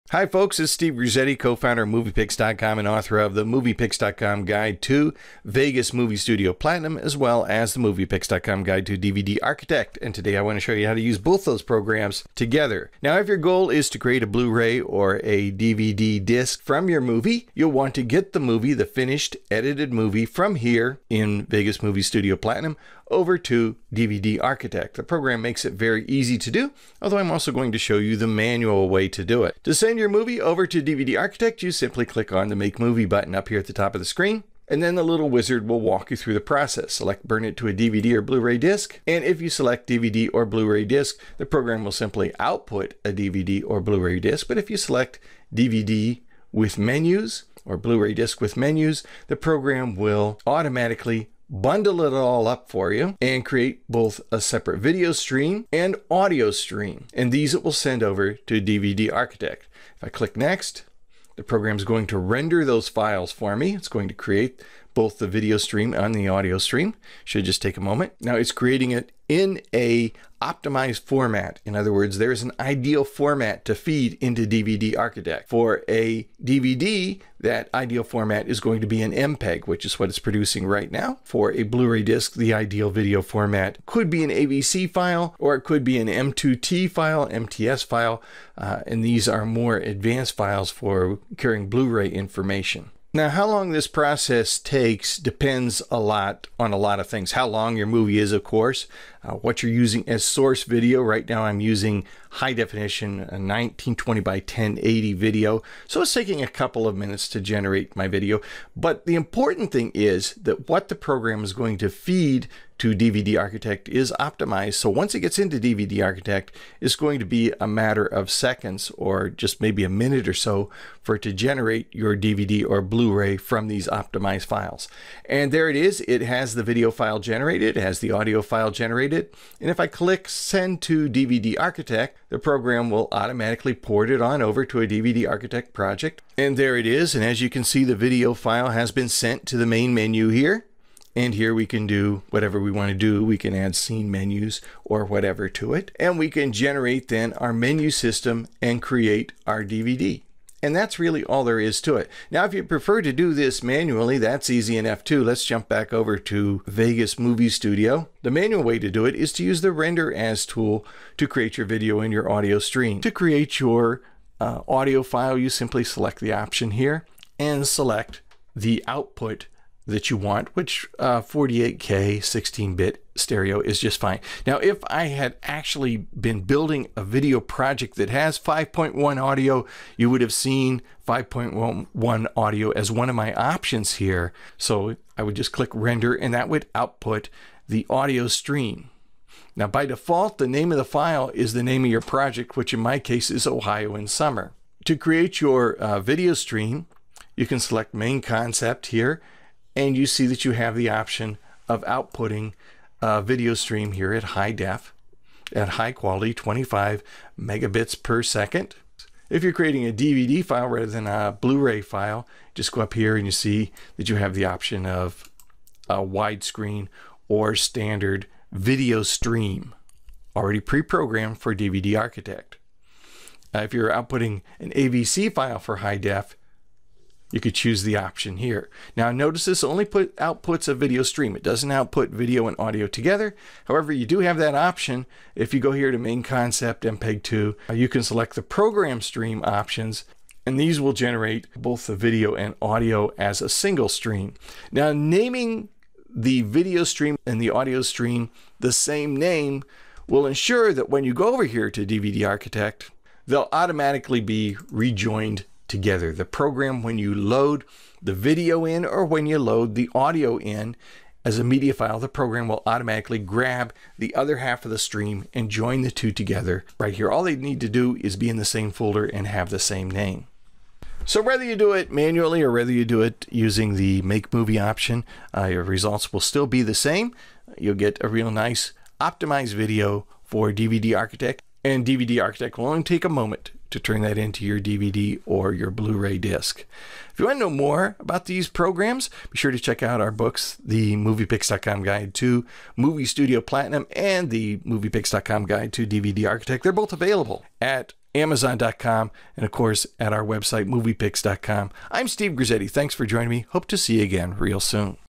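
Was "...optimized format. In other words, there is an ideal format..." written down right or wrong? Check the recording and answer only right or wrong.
right.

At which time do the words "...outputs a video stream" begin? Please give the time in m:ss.
3:50.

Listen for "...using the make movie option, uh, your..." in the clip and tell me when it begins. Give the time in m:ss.
4:33.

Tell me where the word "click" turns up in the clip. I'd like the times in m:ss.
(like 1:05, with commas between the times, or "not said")
0:32, 1:00, 2:09, 3:05.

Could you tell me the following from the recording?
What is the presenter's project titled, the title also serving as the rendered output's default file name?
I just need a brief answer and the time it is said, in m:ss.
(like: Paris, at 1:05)
Ohio in Summer, at 3:13.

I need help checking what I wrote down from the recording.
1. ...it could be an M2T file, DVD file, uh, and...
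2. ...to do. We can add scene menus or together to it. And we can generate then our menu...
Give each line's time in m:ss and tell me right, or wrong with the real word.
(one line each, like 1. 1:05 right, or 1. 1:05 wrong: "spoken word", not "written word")
1. 1:25 wrong: "MTS", not "DVD"
2. 2:22 wrong: "whatever", not "together".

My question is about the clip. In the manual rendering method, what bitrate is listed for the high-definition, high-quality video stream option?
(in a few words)
25 megabits per second.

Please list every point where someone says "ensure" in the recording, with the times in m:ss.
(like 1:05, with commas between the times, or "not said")
4:10.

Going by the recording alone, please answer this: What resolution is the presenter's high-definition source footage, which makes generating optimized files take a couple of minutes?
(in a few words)
1920 by 1080.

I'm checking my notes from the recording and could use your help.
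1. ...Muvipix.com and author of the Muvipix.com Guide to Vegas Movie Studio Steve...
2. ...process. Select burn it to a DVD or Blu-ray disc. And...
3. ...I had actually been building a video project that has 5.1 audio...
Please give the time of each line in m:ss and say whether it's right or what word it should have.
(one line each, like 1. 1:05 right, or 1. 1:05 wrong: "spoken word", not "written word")
1. 0:01 wrong: "Platinum", not "Steve"
2. 0:36 right
3. 2:54 right.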